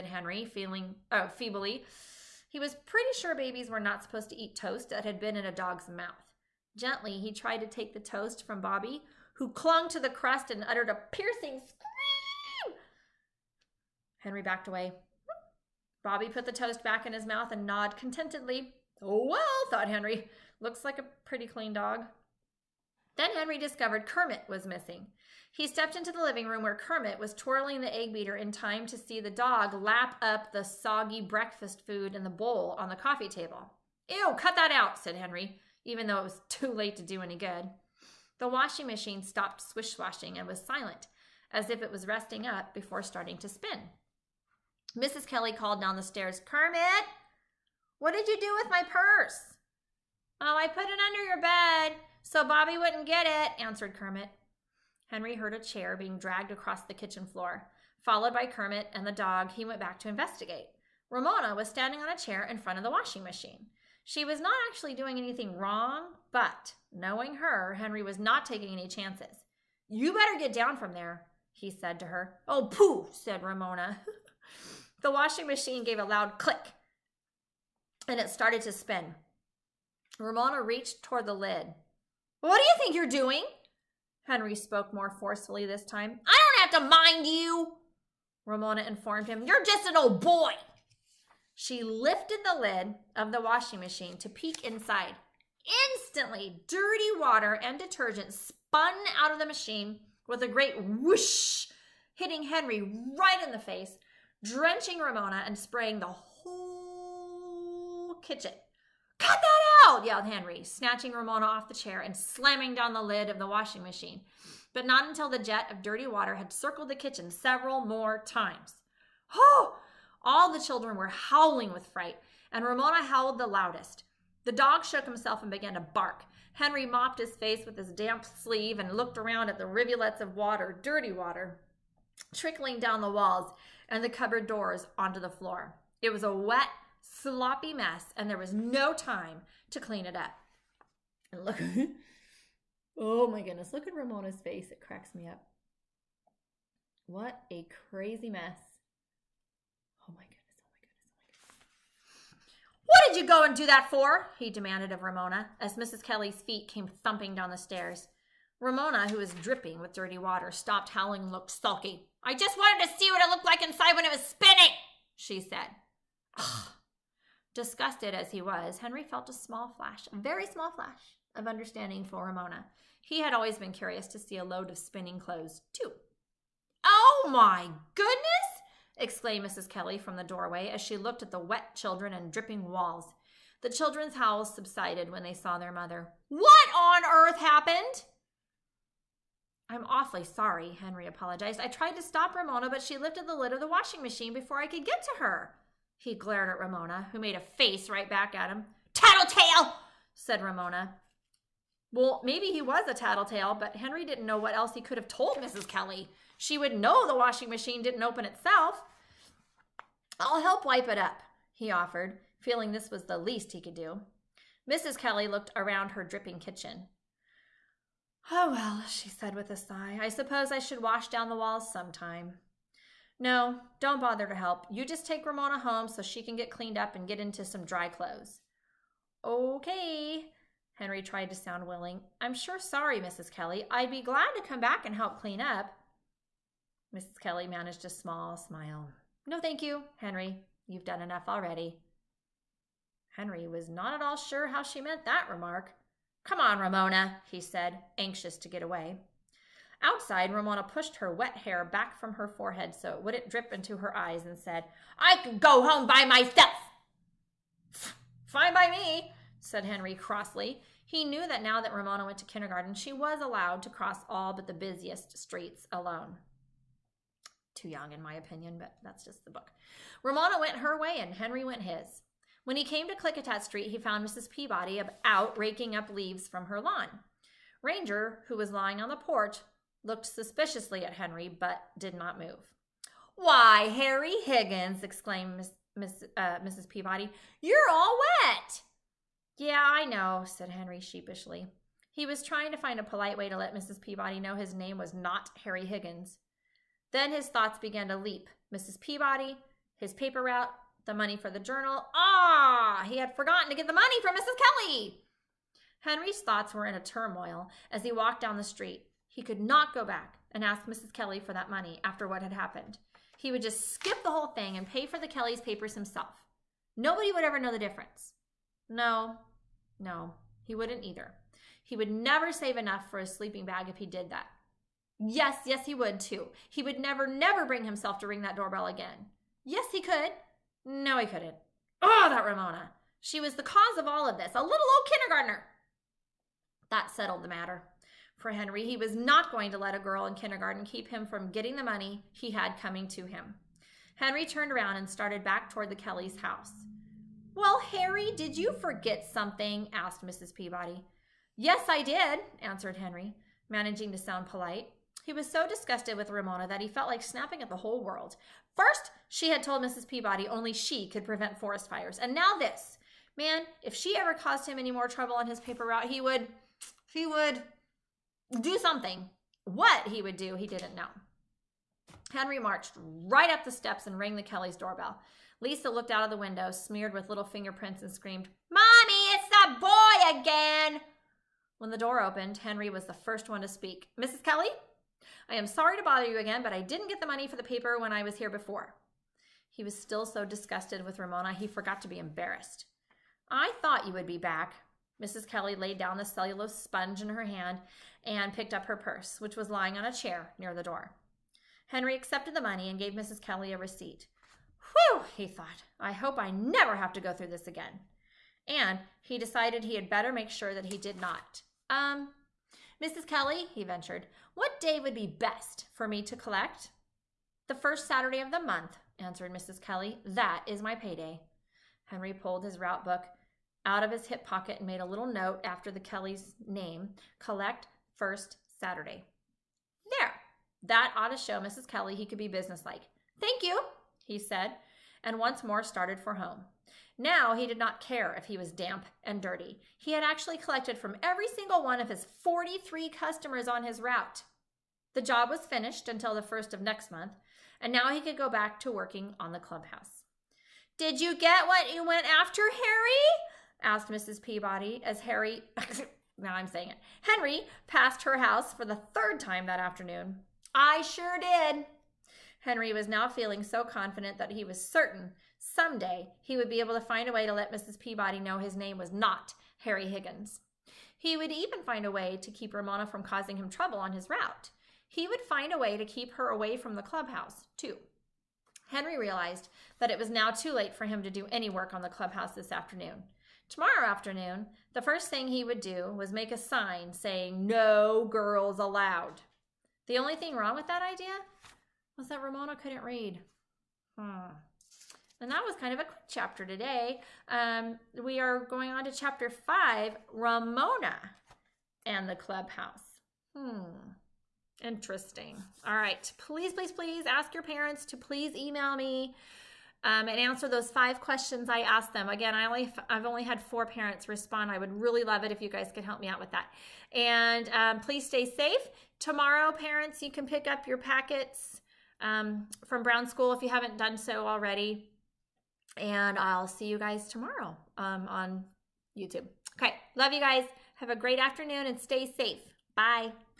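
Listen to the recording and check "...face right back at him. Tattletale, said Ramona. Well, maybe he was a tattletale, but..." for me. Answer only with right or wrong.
right.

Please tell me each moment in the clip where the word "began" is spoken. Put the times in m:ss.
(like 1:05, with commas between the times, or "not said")
2:05, 4:57.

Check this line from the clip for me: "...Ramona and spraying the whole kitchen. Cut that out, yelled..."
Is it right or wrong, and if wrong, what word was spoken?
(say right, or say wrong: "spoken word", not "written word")
right.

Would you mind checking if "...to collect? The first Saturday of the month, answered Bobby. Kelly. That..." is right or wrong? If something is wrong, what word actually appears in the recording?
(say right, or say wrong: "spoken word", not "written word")
wrong: "Mrs", not "Bobby".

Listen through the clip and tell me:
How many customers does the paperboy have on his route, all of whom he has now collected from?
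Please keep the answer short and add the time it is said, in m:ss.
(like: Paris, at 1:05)
43, at 7:22.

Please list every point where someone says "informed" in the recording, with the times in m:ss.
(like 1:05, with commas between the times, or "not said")
1:28.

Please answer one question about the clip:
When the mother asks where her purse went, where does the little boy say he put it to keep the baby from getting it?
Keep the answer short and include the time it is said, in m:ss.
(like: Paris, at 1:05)
Under your bed, at 0:51.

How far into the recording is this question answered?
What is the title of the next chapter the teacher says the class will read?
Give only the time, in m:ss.
8:20.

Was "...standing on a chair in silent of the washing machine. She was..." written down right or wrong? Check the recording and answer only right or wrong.
wrong.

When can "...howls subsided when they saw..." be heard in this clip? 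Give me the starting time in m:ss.
3:04.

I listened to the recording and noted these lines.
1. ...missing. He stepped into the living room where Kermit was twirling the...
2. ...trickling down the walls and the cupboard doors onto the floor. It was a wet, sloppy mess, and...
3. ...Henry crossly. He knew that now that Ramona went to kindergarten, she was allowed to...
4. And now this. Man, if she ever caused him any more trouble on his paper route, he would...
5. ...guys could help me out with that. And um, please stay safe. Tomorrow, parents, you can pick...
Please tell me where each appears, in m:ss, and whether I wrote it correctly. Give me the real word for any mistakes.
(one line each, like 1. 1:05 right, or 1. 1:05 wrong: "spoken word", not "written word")
1. 0:24 right
2. 2:12 right
3. 4:19 right
4. 6:01 right
5. 8:35 right.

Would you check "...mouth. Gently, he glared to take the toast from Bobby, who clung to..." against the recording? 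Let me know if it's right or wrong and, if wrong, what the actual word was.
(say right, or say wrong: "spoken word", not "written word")
wrong: "tried", not "glared".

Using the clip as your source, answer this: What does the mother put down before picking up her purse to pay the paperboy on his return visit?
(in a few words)
Cellulose sponge.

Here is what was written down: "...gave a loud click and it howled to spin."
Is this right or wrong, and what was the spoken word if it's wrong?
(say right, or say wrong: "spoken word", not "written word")
wrong: "started", not "howled".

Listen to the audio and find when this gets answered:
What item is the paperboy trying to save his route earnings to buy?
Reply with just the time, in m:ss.
5:23.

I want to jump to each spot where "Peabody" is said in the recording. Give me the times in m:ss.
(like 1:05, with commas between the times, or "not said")
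4:34, 4:46, 4:53, 4:58, 5:50, 5:59, 7:34, 7:47.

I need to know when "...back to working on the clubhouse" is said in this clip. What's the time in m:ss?
7:28.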